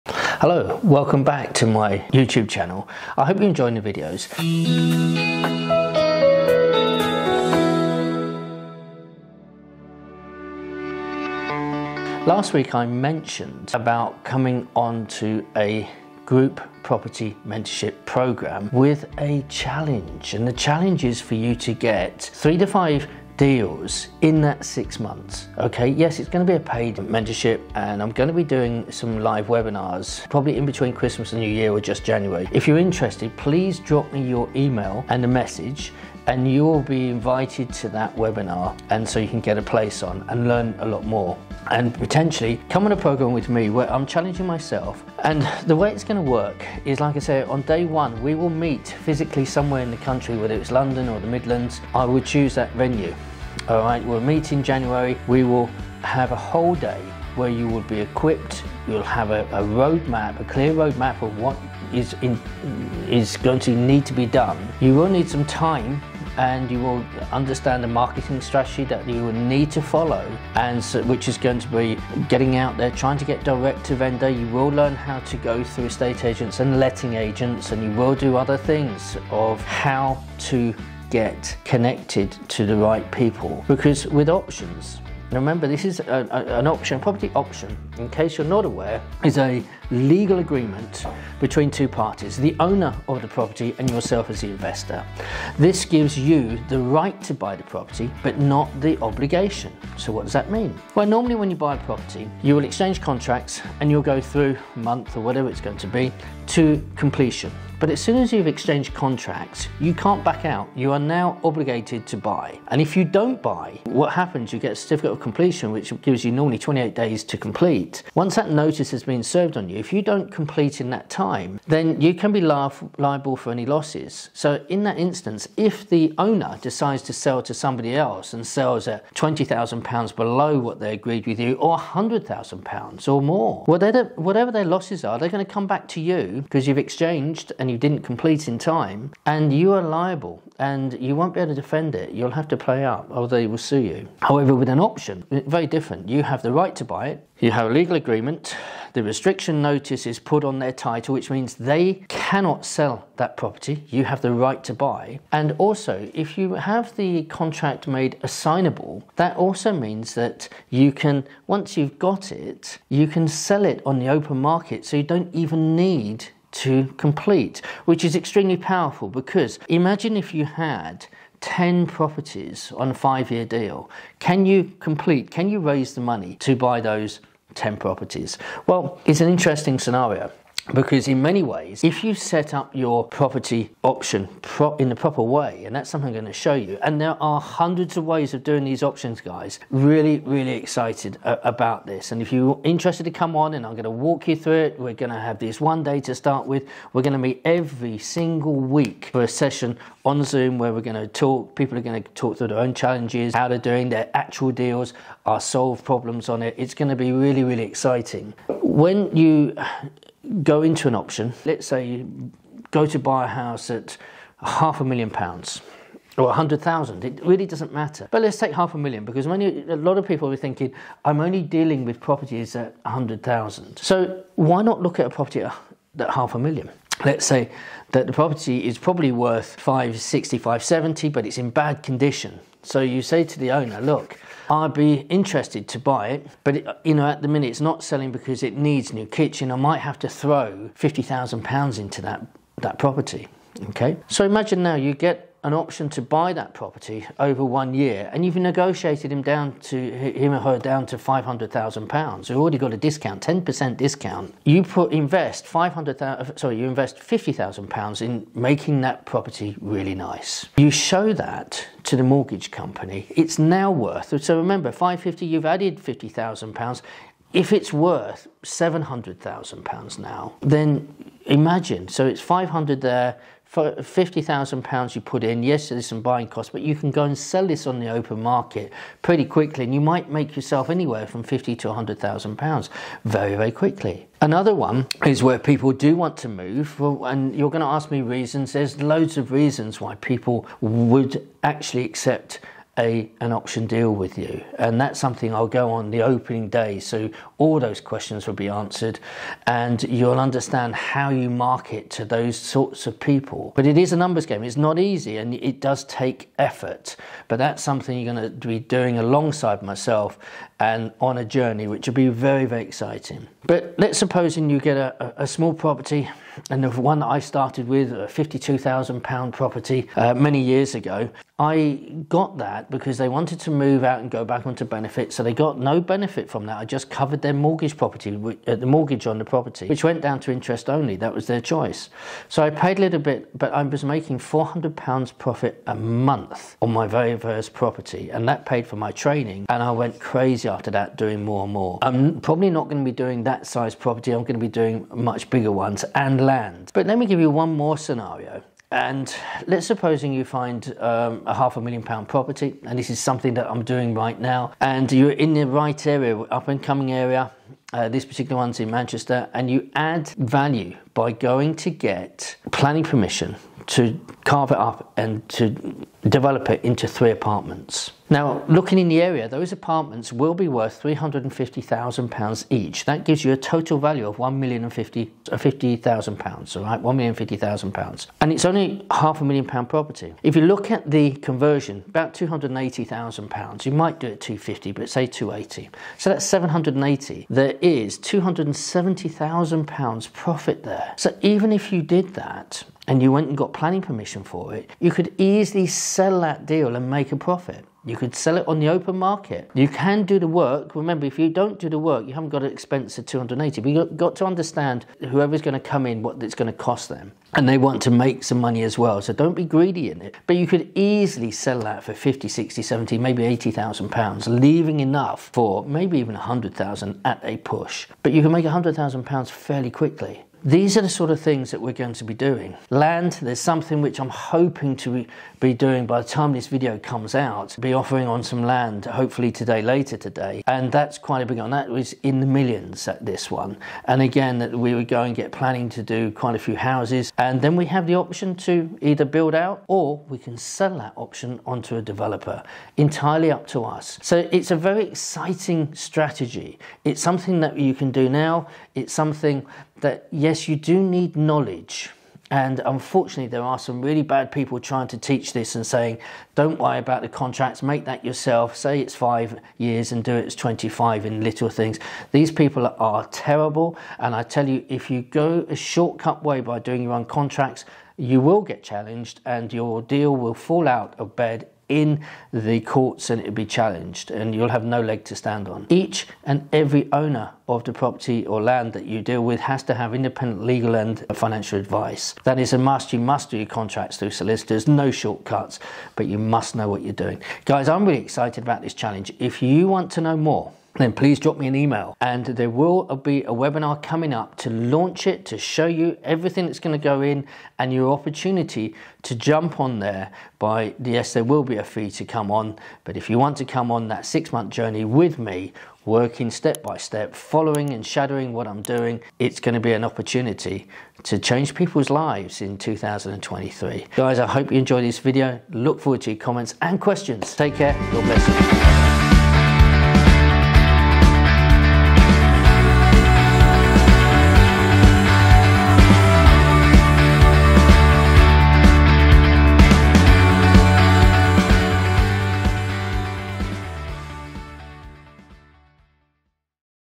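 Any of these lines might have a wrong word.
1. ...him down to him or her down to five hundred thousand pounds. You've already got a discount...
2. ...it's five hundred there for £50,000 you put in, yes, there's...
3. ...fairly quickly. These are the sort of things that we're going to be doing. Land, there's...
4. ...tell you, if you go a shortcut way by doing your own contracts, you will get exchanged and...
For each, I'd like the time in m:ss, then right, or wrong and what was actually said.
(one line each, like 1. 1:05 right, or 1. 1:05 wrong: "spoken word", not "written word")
1. 4:09 right
2. 4:32 right
3. 6:59 right
4. 7:44 wrong: "challenged", not "exchanged".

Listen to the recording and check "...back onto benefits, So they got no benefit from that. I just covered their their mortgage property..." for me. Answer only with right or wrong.
right.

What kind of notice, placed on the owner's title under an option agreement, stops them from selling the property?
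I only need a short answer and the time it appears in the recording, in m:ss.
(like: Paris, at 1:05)
Restriction notice, at 2:28.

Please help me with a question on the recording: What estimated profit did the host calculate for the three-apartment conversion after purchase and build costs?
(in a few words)
£270,000.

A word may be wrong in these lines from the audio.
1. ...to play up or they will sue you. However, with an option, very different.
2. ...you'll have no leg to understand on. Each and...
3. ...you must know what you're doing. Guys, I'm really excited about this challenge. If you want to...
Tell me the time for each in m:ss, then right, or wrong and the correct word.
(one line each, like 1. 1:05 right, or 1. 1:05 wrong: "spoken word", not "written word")
1. 2:22 right
2. 7:54 wrong: "stand", not "understand"
3. 8:06 right.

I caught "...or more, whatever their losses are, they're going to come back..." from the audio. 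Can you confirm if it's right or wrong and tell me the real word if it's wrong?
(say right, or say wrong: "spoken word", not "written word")
right.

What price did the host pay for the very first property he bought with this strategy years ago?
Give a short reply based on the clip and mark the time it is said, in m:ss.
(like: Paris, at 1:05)
£52,000, at 5:18.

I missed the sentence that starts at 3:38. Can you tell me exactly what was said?
But let's take half a million because many a lot of people are thinking, I'm only dealing with properties at 100,000.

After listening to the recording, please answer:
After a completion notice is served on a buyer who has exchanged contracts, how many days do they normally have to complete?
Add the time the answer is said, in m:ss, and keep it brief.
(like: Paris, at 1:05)
28, at 1:56.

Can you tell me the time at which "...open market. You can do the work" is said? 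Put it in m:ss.
6:38.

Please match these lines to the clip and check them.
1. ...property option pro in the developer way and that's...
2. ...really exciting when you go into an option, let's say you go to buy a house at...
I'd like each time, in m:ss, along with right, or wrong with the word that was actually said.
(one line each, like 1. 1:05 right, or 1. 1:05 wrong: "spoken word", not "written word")
1. 3:03 wrong: "proper", not "developer"
2. 3:27 right.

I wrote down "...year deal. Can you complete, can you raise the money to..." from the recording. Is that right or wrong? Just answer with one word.
right.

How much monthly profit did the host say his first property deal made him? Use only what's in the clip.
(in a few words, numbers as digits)
£400.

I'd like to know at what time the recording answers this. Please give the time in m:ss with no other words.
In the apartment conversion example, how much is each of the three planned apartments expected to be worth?
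6:10.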